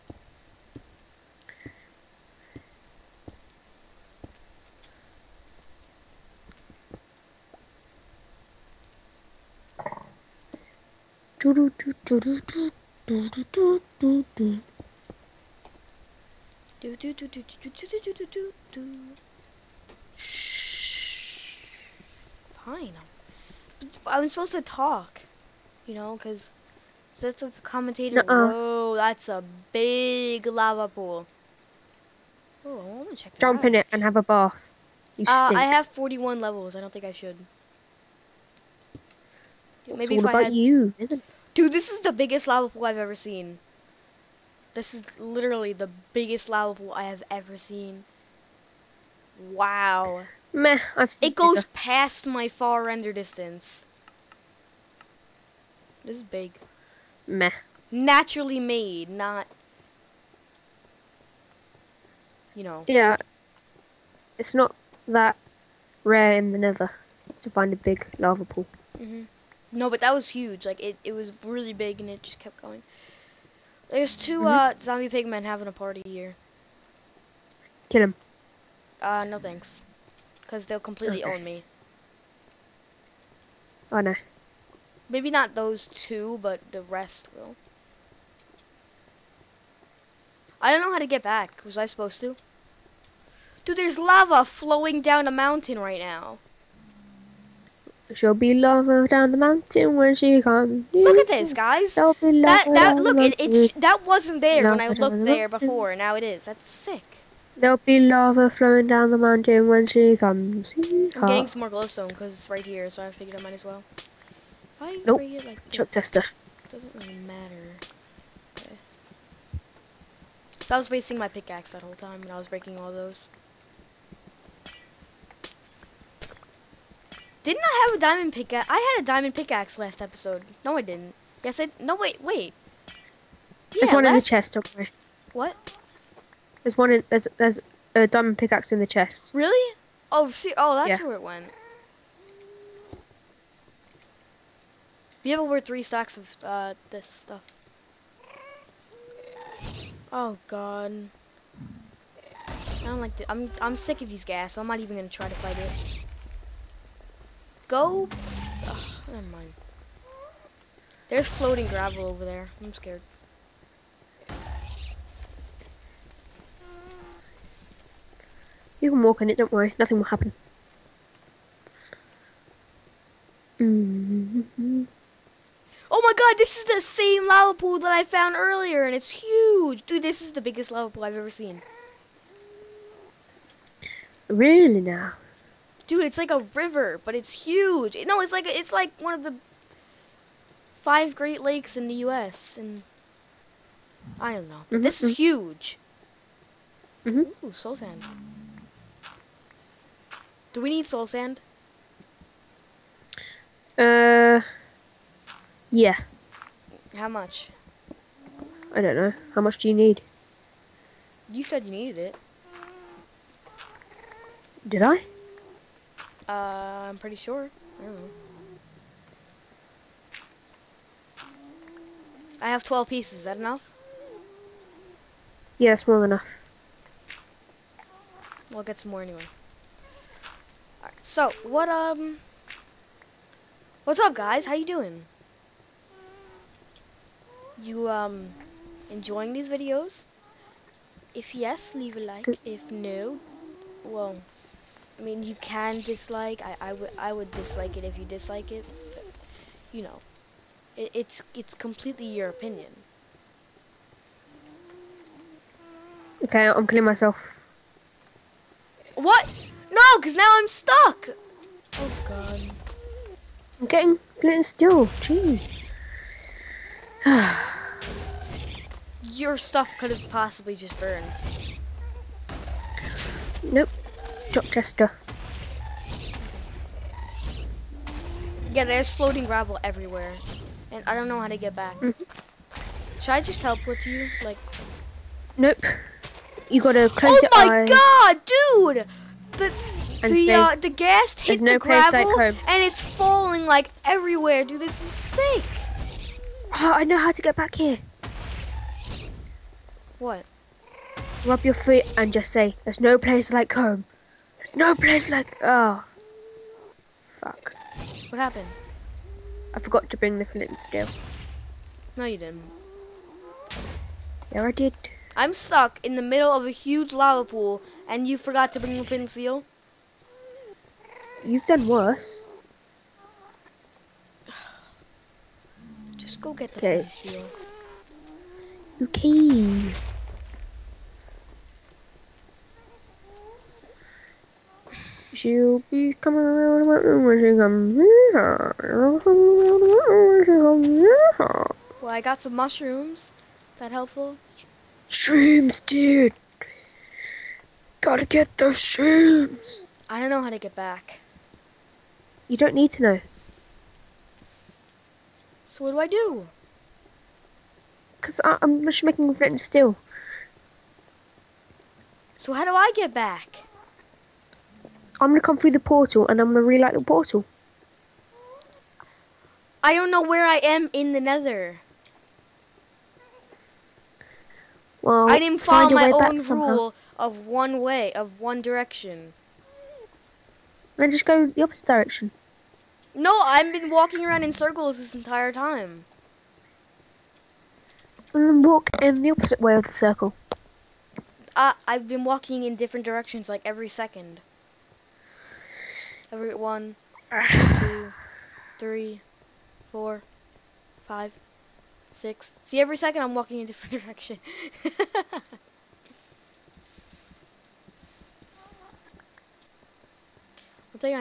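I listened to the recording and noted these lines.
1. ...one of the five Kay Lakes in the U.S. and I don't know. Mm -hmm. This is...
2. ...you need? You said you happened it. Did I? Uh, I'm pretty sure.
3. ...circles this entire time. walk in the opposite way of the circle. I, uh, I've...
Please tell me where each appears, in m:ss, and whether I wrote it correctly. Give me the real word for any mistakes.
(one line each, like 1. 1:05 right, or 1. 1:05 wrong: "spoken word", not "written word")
1. 3:09 wrong: "Great", not "Kay"
2. 3:29 wrong: "needed", not "happened"
3. 6:24 right.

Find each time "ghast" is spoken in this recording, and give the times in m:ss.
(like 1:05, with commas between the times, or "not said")
2:34, 4:50.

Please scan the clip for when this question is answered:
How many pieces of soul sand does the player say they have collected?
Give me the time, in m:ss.
3:42.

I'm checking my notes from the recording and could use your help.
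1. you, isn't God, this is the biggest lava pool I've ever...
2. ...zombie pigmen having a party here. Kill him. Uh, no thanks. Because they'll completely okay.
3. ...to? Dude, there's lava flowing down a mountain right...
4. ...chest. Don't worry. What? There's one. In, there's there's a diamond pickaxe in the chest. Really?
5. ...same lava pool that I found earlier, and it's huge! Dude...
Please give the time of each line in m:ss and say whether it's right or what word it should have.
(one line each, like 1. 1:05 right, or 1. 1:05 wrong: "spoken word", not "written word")
1. 0:40 wrong: "Dude", not "God"
2. 1:14 right
3. 1:32 right
4. 2:14 right
5. 2:56 right.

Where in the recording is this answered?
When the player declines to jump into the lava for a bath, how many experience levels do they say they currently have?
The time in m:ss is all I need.
0:35.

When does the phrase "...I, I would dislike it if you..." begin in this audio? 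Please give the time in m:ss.
4:06.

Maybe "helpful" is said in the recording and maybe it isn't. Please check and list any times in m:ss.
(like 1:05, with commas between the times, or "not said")
5:43.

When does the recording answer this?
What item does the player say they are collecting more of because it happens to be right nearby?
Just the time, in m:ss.
1:51.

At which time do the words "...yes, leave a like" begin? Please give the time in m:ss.
4:01.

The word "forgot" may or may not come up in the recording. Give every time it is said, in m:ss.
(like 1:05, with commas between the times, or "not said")
5:09, 5:18.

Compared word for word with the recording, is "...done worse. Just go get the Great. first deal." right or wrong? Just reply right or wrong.
wrong.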